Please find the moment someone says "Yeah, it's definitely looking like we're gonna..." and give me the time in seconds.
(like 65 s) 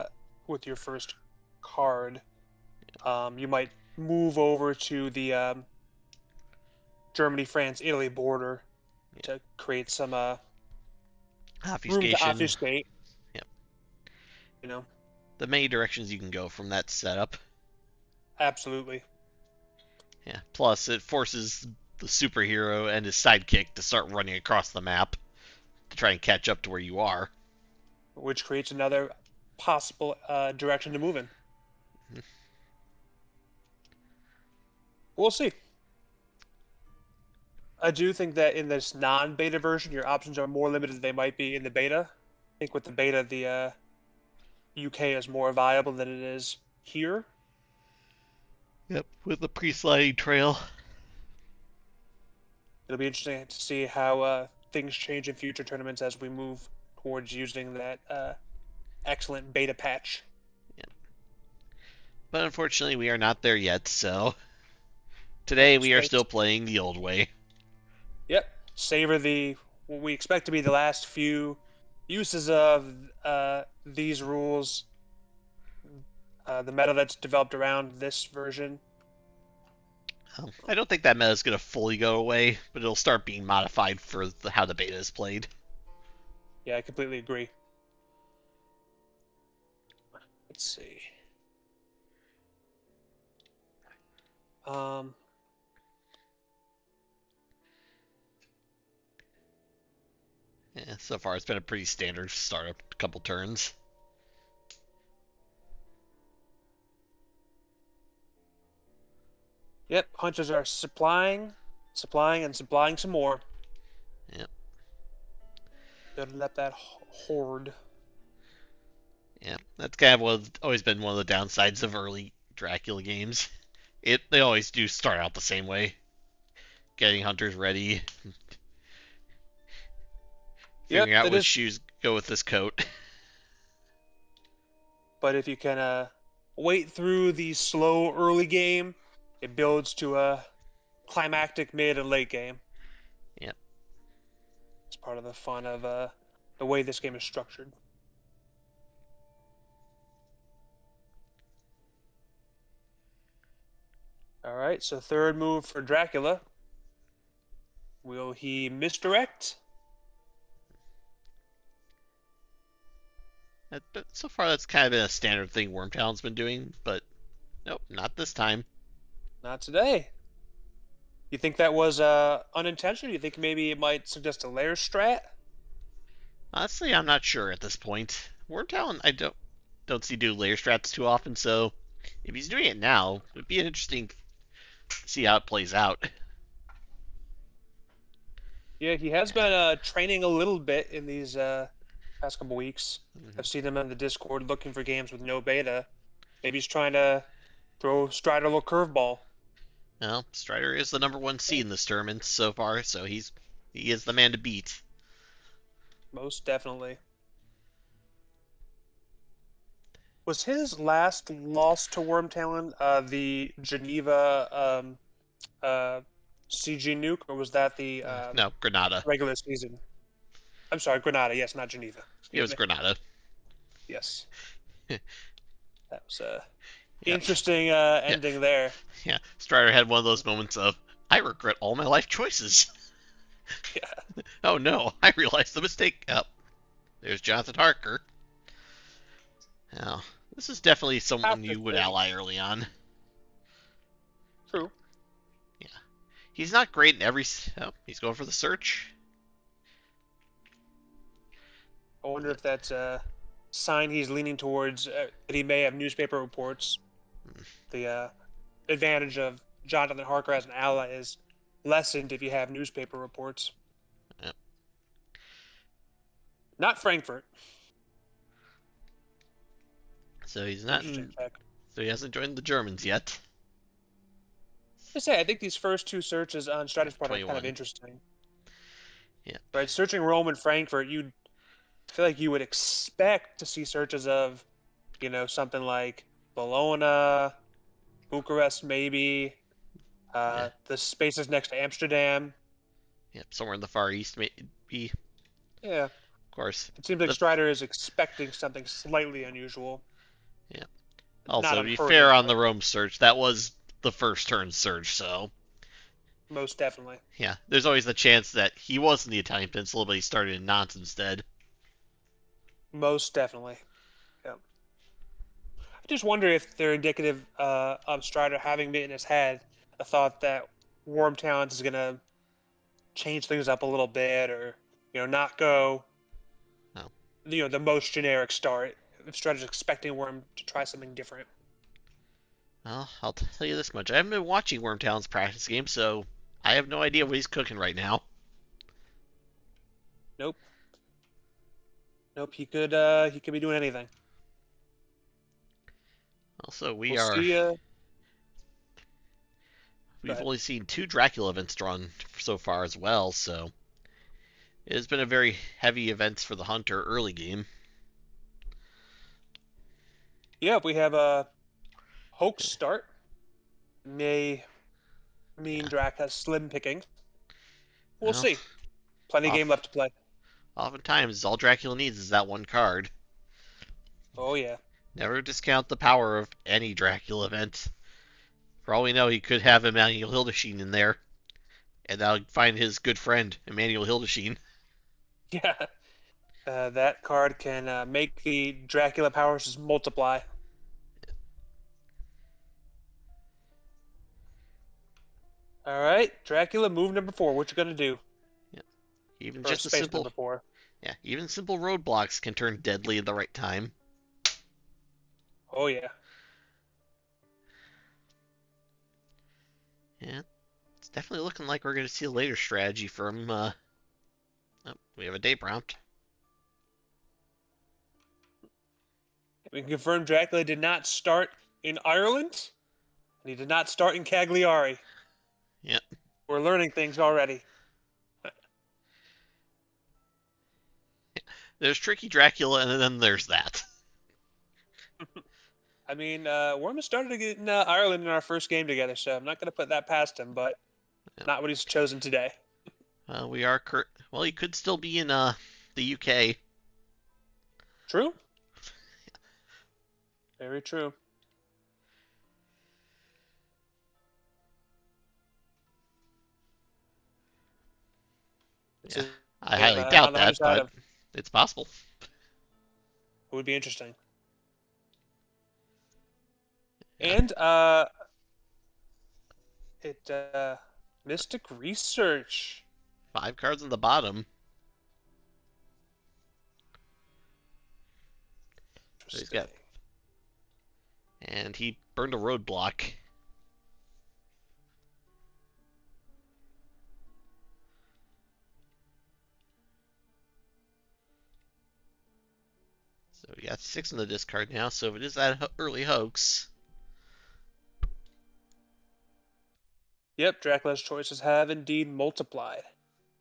409 s.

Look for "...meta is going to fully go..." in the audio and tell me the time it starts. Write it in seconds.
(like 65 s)
81 s.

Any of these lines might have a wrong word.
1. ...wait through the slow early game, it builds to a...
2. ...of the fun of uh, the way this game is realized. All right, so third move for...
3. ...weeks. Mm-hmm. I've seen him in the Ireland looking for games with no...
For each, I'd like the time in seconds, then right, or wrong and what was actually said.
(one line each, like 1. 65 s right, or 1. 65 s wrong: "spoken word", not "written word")
1. 136 s right
2. 145 s wrong: "structured", not "realized"
3. 192 s wrong: "Discord", not "Ireland".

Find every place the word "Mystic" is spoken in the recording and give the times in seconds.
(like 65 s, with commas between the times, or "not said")
471 s.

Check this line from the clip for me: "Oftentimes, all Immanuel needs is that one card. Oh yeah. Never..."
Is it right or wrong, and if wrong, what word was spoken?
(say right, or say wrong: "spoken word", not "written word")
wrong: "Dracula", not "Immanuel".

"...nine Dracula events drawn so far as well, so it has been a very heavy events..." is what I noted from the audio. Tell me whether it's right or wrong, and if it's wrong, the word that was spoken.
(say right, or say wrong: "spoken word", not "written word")
wrong: "two", not "nine".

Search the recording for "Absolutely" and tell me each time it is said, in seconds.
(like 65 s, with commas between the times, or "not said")
18 s.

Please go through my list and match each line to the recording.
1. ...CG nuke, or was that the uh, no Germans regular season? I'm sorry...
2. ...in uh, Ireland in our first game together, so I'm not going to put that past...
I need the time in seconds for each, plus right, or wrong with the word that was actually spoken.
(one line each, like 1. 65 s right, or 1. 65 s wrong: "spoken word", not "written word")
1. 216 s wrong: "Granada", not "Germans"
2. 437 s right.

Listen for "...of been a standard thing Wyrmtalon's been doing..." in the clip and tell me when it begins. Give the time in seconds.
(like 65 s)
164 s.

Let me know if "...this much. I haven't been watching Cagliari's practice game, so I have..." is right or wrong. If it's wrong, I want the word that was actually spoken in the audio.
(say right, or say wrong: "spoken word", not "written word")
wrong: "Wyrmtalon", not "Cagliari".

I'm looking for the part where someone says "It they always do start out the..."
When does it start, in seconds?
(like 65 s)
124 s.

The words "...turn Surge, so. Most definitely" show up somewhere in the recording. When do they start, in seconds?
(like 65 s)
304 s.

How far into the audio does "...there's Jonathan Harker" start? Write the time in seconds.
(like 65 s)
237 s.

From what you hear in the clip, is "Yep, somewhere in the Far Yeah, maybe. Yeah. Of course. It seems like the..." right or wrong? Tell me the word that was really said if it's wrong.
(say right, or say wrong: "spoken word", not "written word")
wrong: "East", not "Yeah".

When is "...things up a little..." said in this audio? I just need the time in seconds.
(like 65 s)
323 s.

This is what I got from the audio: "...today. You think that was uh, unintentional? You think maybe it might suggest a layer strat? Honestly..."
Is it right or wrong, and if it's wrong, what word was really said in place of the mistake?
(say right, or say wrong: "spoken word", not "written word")
right.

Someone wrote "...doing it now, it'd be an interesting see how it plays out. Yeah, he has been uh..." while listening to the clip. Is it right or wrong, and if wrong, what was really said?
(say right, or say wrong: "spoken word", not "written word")
right.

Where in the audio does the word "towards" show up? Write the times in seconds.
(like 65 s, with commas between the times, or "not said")
57 s, 254 s.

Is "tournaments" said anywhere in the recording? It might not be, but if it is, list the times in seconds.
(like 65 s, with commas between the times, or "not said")
55 s, 201 s.